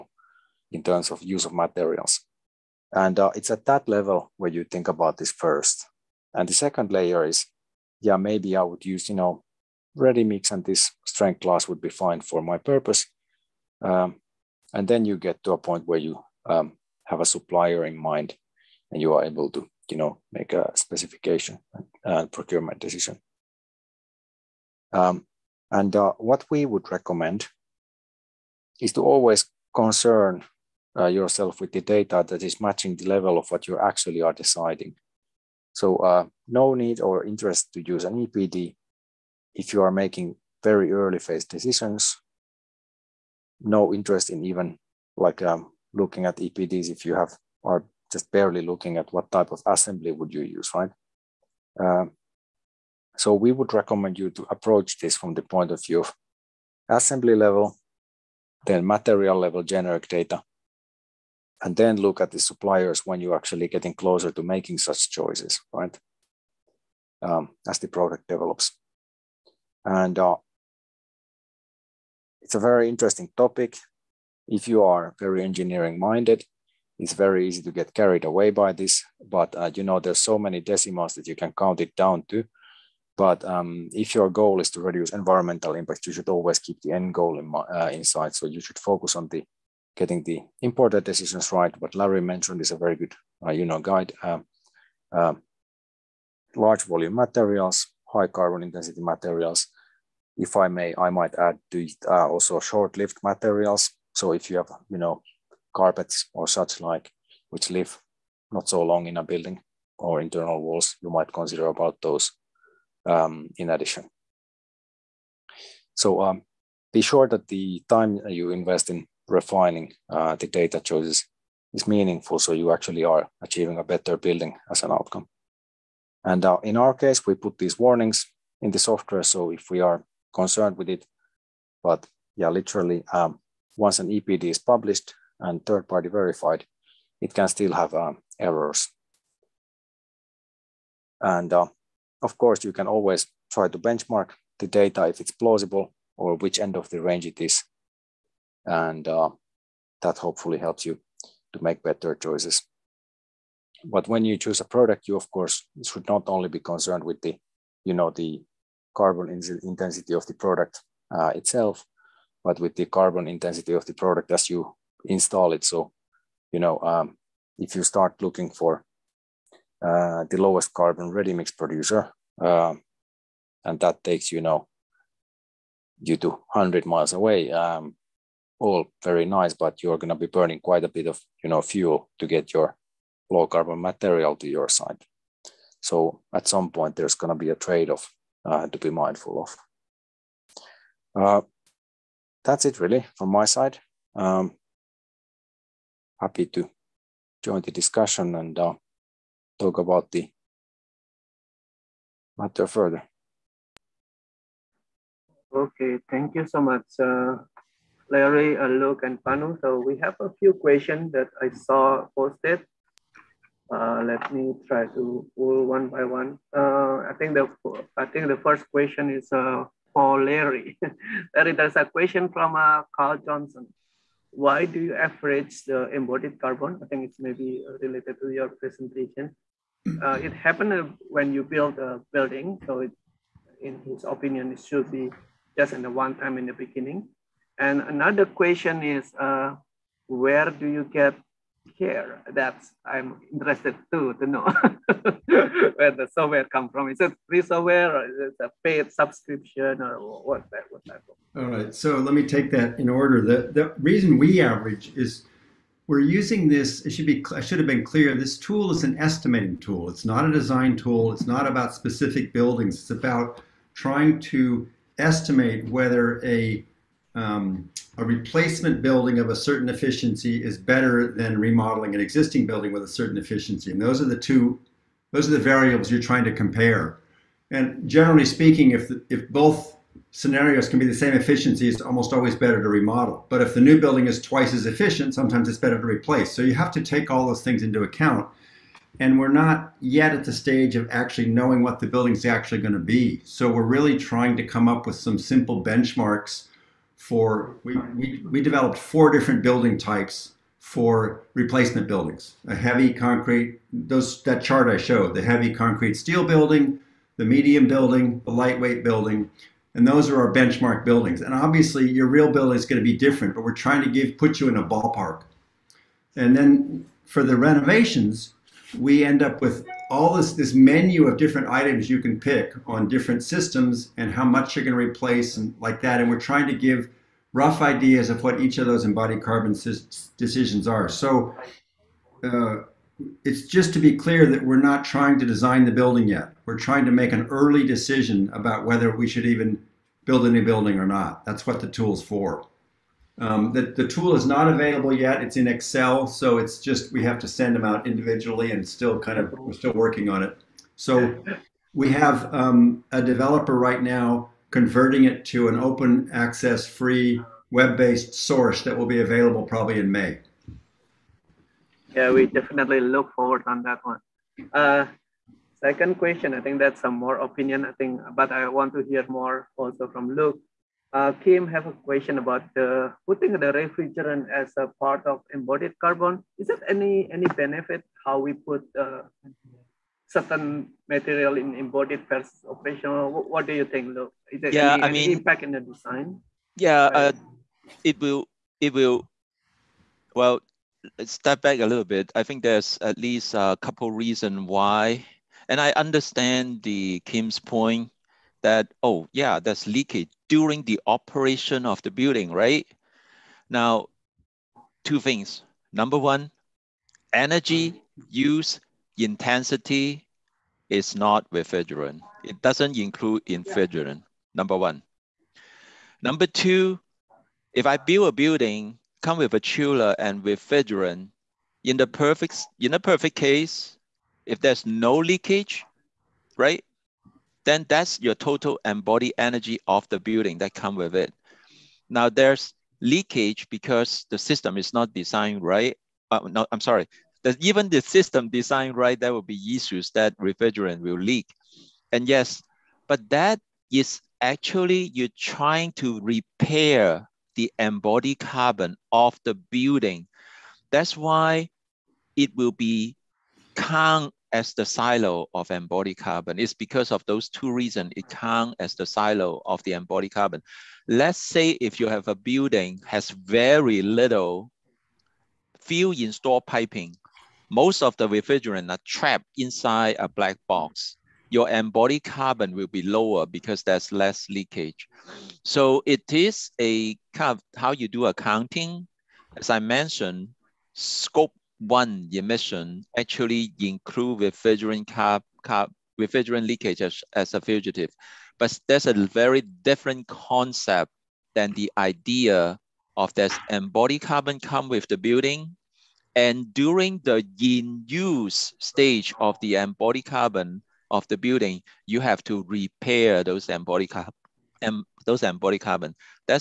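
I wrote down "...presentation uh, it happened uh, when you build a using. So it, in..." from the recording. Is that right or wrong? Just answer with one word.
wrong.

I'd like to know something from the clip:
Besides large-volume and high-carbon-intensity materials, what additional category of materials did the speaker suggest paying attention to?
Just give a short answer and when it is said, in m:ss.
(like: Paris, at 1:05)
short-lived materials, at 1:42.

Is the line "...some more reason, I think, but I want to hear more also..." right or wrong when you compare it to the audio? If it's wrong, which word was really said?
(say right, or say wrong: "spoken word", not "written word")
wrong: "opinion", not "reason".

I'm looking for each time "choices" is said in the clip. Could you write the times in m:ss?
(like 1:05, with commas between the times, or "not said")
1:05, 2:00, 2:32.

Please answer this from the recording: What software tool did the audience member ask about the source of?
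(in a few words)
CARE.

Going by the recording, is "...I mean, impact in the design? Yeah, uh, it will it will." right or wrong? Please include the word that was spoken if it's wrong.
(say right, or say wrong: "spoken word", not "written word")
right.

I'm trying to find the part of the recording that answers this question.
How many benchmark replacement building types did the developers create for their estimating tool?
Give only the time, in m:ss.
4:58.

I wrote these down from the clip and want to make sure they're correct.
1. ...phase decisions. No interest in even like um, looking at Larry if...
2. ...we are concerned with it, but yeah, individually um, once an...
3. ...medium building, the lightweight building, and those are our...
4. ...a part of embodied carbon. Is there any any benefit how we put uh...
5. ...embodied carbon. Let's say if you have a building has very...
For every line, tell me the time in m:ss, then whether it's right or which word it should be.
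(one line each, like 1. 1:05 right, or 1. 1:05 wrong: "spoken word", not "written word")
1. 0:41 wrong: "EPDs", not "Larry"
2. 2:09 wrong: "literally", not "individually"
3. 5:07 right
4. 6:14 right
5. 7:39 right.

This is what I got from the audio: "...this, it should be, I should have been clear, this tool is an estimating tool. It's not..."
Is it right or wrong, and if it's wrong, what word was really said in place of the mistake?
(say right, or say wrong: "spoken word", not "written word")
right.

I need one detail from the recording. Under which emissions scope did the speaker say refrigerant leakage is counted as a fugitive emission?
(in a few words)
scope one.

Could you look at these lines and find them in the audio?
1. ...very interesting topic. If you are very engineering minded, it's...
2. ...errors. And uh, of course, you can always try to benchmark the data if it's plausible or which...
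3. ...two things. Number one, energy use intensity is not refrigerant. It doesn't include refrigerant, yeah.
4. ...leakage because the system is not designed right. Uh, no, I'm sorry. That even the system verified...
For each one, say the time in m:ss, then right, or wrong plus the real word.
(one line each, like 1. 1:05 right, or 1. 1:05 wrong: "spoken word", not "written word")
1. 1:12 right
2. 2:18 right
3. 6:44 right
4. 7:12 wrong: "designed", not "verified".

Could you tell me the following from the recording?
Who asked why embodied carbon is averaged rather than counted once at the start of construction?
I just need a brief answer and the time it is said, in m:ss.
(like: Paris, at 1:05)
Carl Johnson, at 3:42.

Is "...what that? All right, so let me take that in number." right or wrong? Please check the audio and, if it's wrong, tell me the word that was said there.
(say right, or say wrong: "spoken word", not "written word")
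wrong: "order", not "number".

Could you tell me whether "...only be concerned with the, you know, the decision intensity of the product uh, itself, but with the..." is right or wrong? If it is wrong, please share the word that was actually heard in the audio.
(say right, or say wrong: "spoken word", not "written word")
wrong: "carbon", not "decision".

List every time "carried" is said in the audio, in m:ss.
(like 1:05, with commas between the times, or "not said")
1:17.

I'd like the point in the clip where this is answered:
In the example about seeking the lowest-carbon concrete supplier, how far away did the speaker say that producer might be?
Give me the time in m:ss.
2:56.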